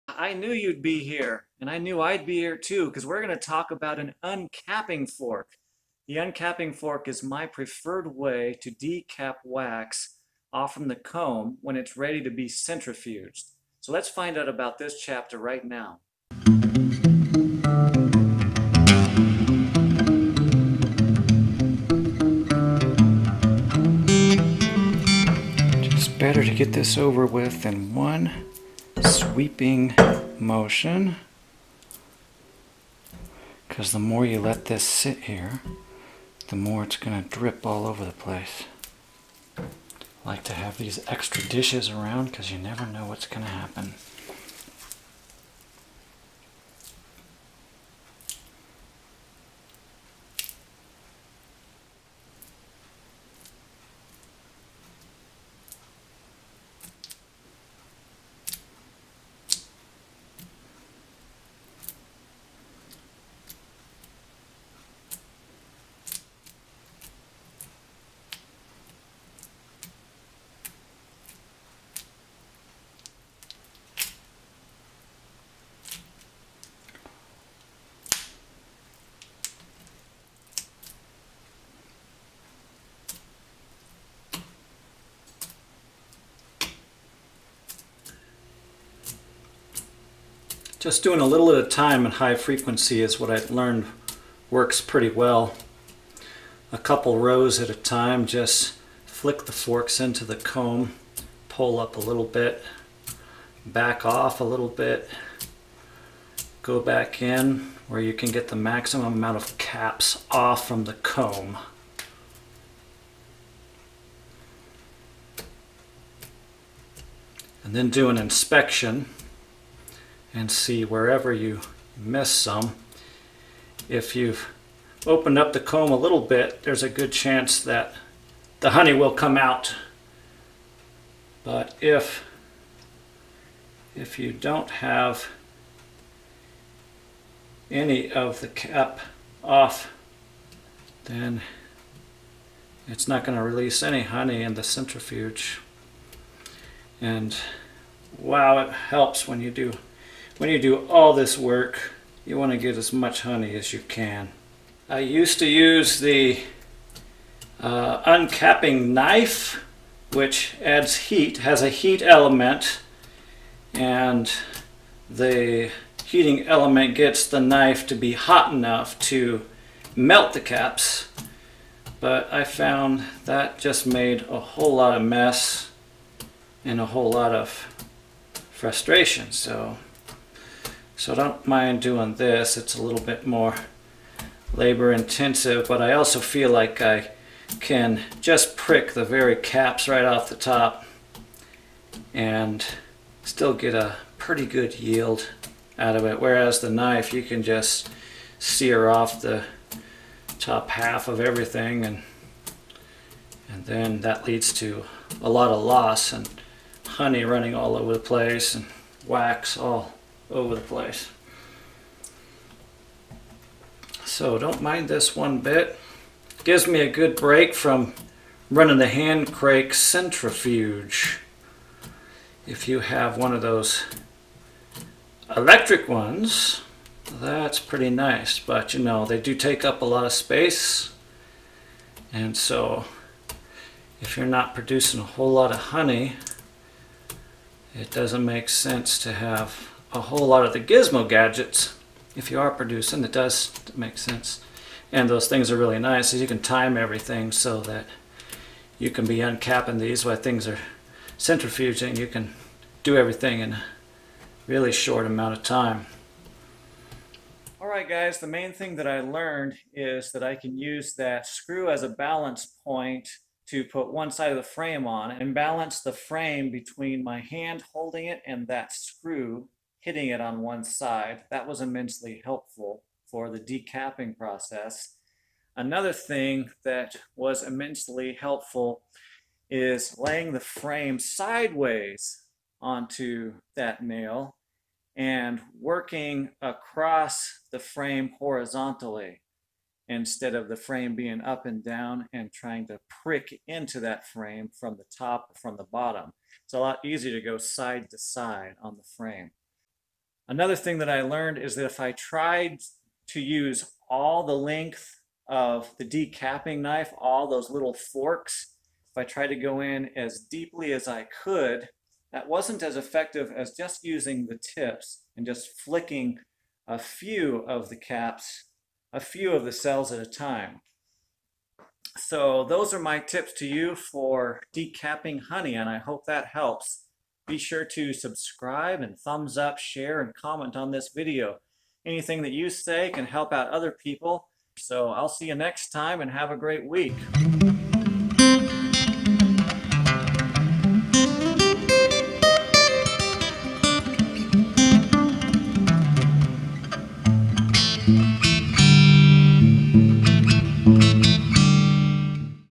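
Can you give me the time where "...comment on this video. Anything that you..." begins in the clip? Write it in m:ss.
5:30.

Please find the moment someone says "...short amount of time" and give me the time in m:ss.
4:14.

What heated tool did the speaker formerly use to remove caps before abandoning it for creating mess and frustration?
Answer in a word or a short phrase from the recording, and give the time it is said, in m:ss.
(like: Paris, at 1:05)
uncapping knife, at 2:38.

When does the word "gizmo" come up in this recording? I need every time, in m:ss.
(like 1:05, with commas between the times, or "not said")
4:00.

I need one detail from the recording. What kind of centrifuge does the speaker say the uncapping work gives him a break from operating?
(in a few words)
hand crank centrifuge.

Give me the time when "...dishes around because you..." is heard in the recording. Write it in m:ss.
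0:41.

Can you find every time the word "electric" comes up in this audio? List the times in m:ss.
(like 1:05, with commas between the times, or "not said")
3:45.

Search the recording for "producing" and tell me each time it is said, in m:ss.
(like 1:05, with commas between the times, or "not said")
3:54, 4:02.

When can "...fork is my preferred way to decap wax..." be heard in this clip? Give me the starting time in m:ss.
0:06.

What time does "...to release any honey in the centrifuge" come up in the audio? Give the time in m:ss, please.
2:23.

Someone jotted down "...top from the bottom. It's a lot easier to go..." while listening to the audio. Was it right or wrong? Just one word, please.
right.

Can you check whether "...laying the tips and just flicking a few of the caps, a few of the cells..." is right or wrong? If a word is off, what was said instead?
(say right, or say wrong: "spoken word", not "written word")
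wrong: "using", not "laying".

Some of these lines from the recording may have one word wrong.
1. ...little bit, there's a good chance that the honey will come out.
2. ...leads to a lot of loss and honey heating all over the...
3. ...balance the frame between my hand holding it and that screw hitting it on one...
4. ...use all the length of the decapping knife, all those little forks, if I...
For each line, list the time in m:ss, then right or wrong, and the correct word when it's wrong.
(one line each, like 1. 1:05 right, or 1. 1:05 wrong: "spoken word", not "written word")
1. 2:05 right
2. 3:24 wrong: "running", not "heating"
3. 4:25 right
4. 5:03 right.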